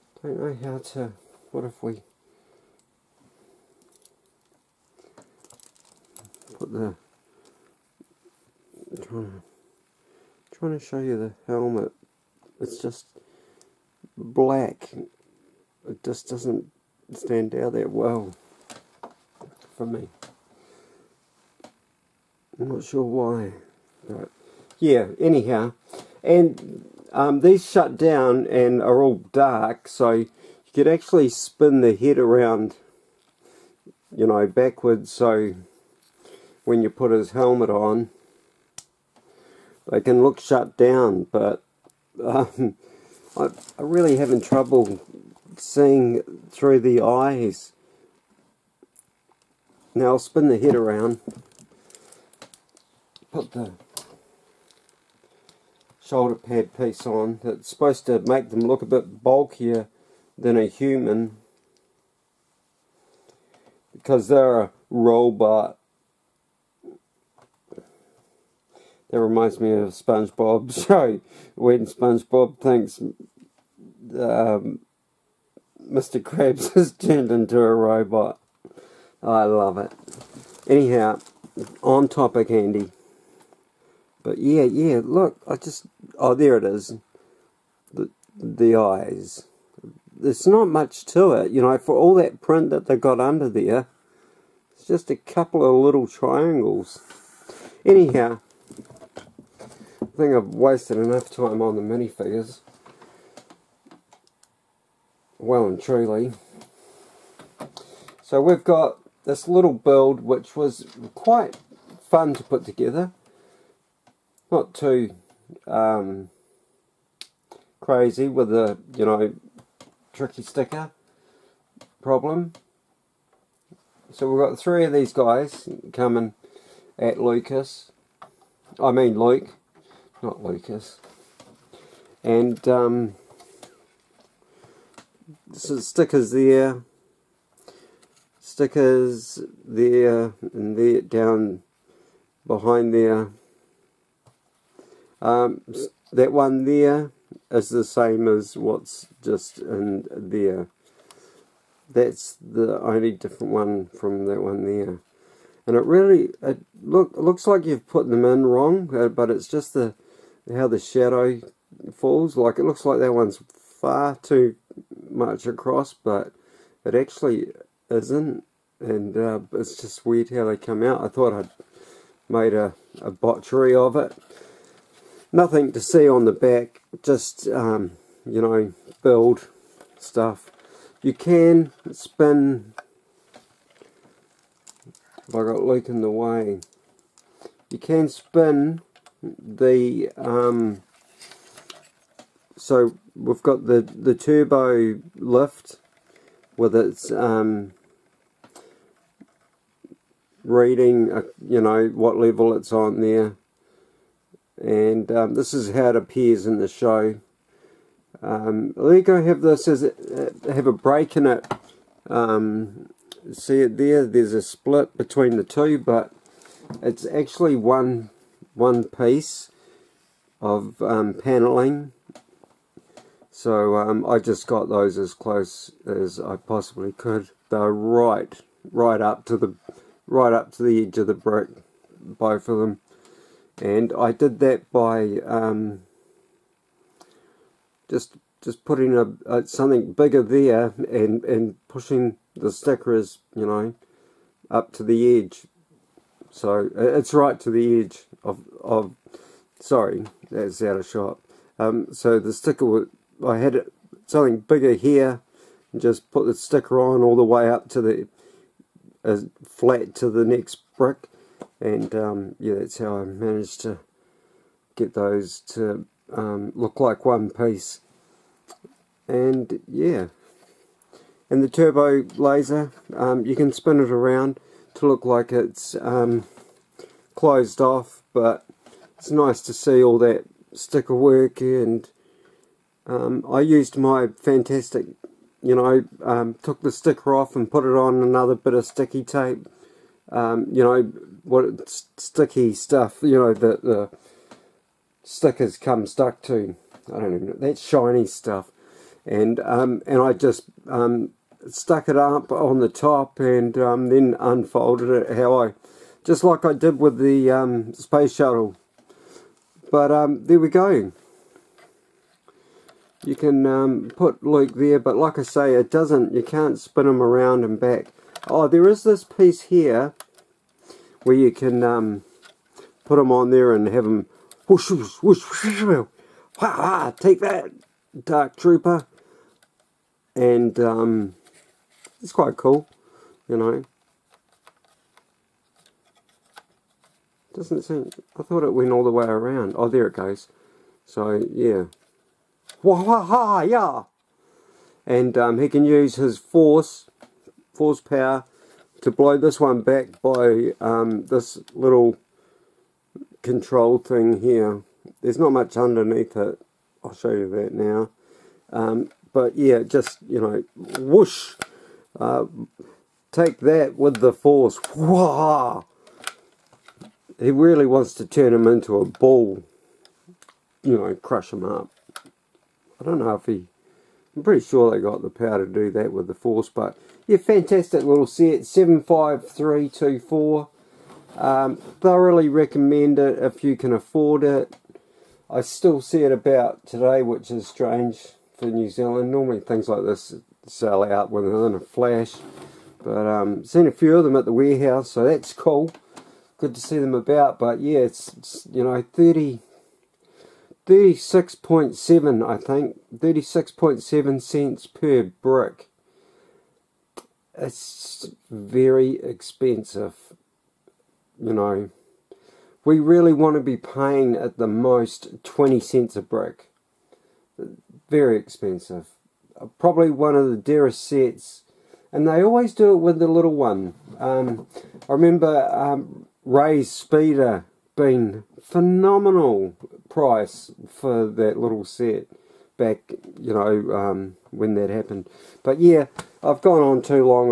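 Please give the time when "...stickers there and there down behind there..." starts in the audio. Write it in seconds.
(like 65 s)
138 s.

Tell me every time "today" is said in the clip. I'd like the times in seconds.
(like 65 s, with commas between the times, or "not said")
386 s.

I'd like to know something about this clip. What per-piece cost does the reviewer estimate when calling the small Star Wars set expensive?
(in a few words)
36.7 cents.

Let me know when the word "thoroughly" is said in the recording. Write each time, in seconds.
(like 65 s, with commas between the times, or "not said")
381 s.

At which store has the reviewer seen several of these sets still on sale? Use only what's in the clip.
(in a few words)
The Warehouse.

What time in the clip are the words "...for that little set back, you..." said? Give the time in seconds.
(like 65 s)
430 s.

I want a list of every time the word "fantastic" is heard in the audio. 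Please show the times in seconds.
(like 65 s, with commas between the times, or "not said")
284 s, 377 s.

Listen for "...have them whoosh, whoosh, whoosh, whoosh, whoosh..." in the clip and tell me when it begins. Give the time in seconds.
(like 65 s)
323 s.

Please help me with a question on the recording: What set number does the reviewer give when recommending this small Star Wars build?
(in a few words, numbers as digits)
75324.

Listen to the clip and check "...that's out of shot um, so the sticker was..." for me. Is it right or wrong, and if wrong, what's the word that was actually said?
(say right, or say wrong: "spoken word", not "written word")
right.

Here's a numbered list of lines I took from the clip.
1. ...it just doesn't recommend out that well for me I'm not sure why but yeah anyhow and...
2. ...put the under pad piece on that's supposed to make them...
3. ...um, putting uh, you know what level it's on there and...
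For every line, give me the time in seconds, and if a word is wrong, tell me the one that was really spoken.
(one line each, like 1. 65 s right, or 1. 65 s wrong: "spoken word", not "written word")
1. 15 s wrong: "stand", not "recommend"
2. 53 s wrong: "shoulder", not "under"
3. 197 s wrong: "reading", not "putting".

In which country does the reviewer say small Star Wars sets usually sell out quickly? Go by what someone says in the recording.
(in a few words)
New Zealand.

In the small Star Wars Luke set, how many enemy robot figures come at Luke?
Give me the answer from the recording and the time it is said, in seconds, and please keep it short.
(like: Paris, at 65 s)
3, at 124 s.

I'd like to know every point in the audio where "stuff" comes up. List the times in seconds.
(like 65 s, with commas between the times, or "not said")
179 s, 292 s, 298 s.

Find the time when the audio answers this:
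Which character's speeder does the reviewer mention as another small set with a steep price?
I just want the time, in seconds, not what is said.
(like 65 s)
426 s.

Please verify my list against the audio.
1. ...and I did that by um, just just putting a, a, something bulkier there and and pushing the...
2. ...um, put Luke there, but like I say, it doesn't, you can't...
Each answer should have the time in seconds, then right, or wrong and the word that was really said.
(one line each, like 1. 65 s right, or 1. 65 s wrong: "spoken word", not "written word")
1. 233 s wrong: "bigger", not "bulkier"
2. 313 s right.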